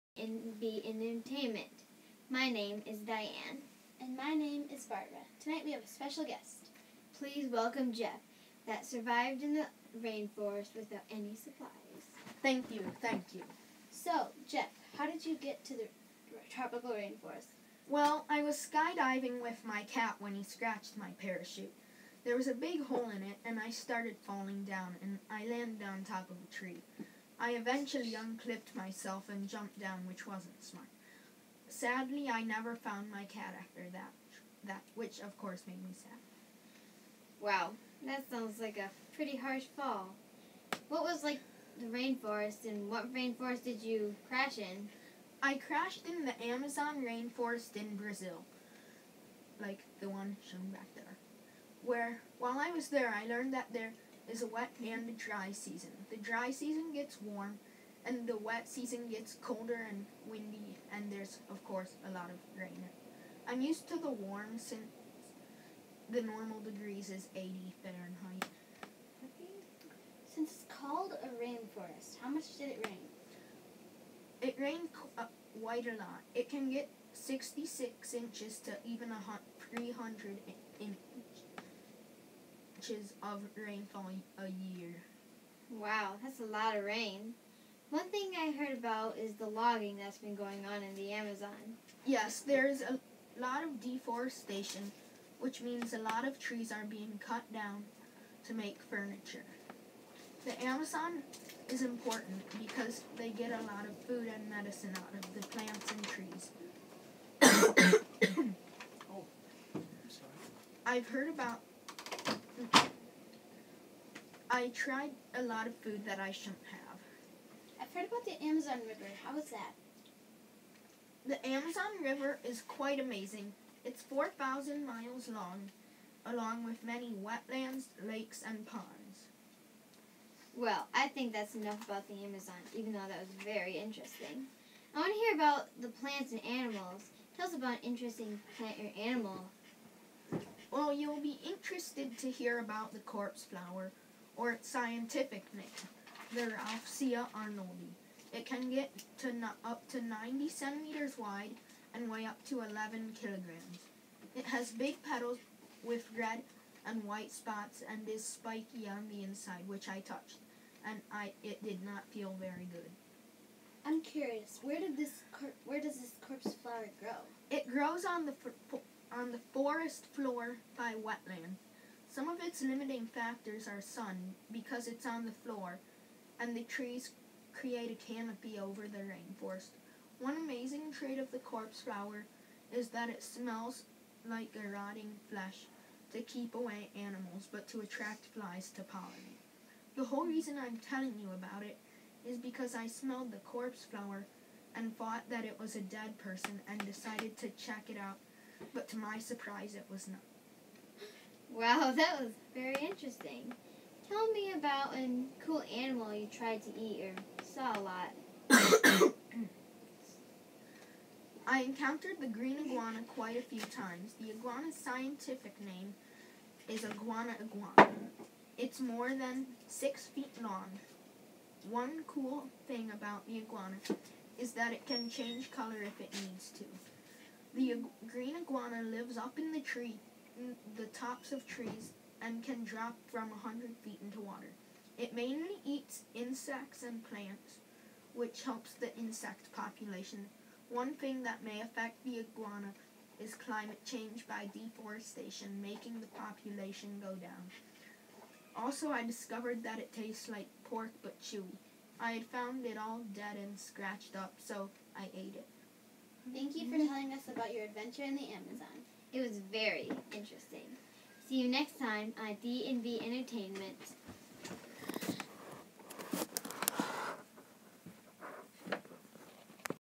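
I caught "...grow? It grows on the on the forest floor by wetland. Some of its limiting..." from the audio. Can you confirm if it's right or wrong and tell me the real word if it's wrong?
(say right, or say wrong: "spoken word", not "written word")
right.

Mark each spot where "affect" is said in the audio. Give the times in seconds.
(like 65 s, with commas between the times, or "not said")
241 s.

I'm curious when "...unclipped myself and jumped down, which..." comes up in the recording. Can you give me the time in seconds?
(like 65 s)
28 s.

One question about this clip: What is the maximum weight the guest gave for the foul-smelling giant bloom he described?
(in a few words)
11 kilograms.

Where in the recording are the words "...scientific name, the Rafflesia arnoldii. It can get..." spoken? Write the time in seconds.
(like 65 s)
144 s.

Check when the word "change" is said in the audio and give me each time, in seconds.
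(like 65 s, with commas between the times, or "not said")
225 s, 243 s.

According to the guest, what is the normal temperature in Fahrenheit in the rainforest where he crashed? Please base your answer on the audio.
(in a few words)
80 degrees Fahrenheit.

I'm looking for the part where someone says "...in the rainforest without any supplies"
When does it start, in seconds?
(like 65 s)
9 s.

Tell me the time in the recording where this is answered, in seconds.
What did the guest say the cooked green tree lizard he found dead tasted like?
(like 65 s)
250 s.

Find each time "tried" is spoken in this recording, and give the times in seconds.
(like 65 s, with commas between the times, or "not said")
114 s, 206 s.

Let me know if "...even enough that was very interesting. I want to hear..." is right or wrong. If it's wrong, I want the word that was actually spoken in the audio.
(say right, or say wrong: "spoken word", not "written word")
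wrong: "though", not "enough".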